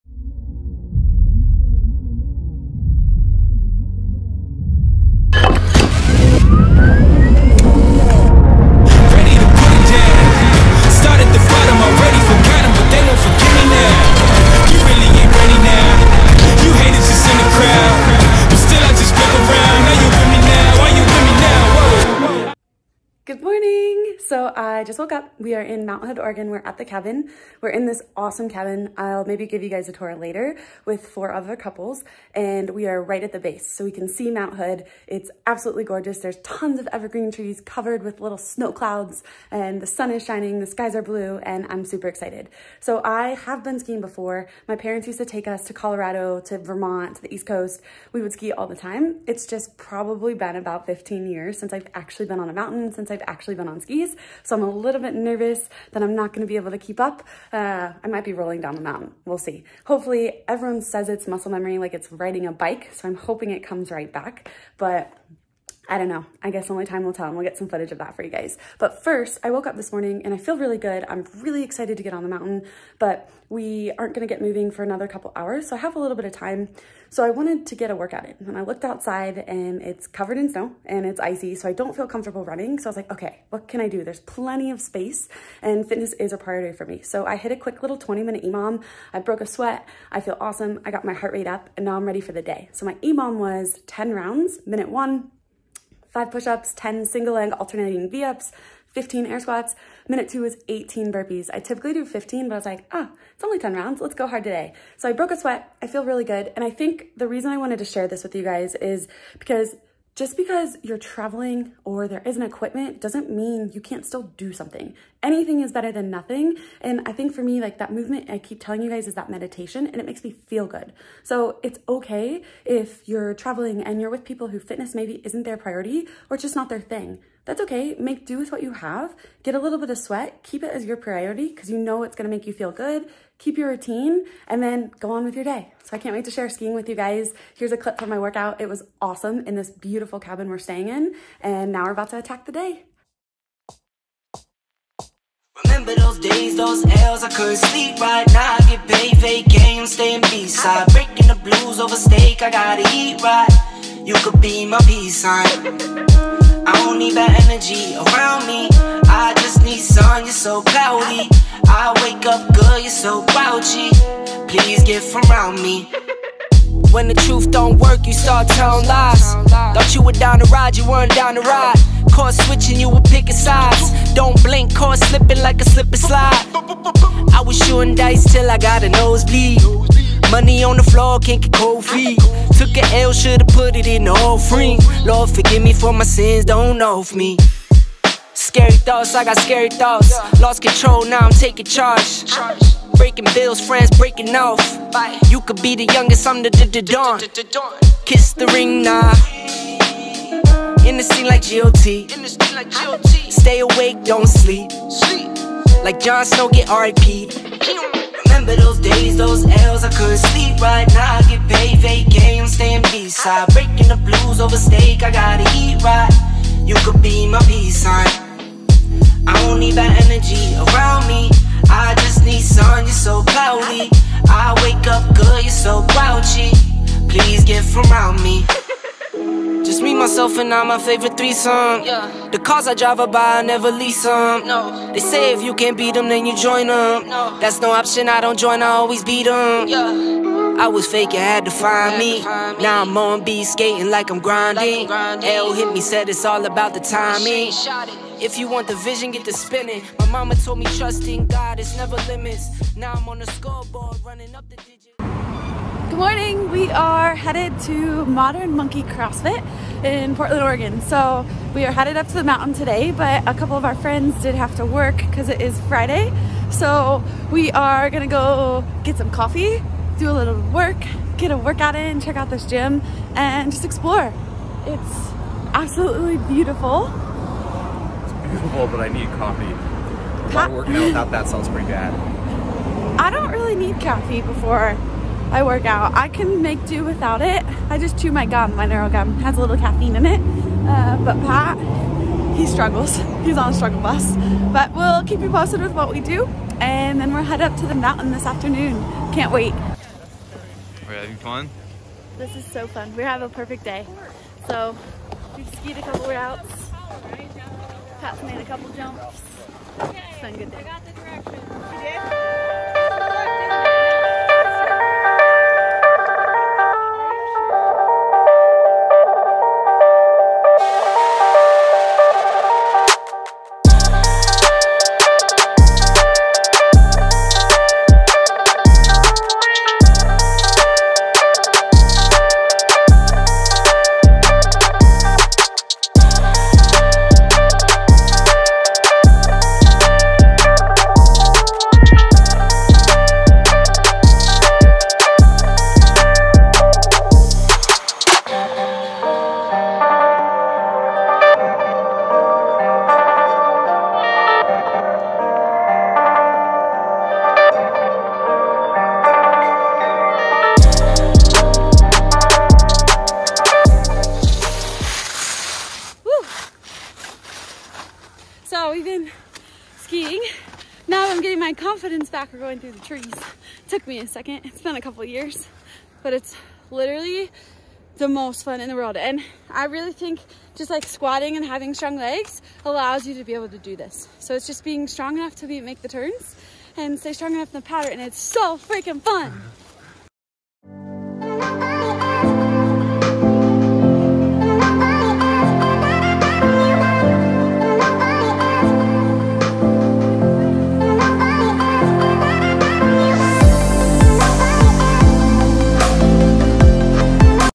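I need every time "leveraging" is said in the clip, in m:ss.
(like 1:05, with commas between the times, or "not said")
not said.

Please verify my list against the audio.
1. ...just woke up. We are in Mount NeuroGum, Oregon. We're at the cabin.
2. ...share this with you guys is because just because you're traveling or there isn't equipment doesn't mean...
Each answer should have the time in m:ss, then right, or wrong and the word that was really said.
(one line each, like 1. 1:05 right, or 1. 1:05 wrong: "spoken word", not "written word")
1. 0:24 wrong: "Hood", not "NeuroGum"
2. 1:47 right.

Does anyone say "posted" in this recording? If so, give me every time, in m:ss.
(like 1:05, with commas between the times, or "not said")
4:55.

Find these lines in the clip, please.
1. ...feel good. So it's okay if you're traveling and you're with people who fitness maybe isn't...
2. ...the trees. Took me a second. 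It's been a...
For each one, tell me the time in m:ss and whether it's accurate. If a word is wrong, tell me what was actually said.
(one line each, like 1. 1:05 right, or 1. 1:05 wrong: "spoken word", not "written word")
1. 2:00 right
2. 6:12 right.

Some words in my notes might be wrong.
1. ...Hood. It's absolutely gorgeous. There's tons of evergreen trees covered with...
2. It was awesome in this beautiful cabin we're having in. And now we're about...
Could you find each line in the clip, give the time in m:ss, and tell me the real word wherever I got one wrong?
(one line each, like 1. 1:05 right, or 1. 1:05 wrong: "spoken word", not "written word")
1. 0:34 right
2. 2:18 wrong: "staying", not "having".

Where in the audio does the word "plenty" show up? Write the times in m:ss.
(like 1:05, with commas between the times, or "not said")
1:24.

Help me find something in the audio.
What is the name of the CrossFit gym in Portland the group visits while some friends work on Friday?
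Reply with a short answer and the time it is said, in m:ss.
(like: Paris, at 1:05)
Modern Monkey CrossFit, at 4:18.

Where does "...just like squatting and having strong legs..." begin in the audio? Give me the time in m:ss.
6:20.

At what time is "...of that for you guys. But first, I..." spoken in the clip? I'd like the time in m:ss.
1:07.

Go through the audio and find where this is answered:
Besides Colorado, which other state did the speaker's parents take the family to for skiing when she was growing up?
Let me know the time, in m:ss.
0:46.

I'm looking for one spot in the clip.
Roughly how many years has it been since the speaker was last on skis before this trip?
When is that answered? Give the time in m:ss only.
0:50.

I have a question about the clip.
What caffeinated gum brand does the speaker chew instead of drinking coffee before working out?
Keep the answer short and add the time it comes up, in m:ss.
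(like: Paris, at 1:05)
NeuroGum, at 4:48.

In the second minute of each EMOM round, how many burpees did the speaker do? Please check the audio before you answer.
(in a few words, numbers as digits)
18.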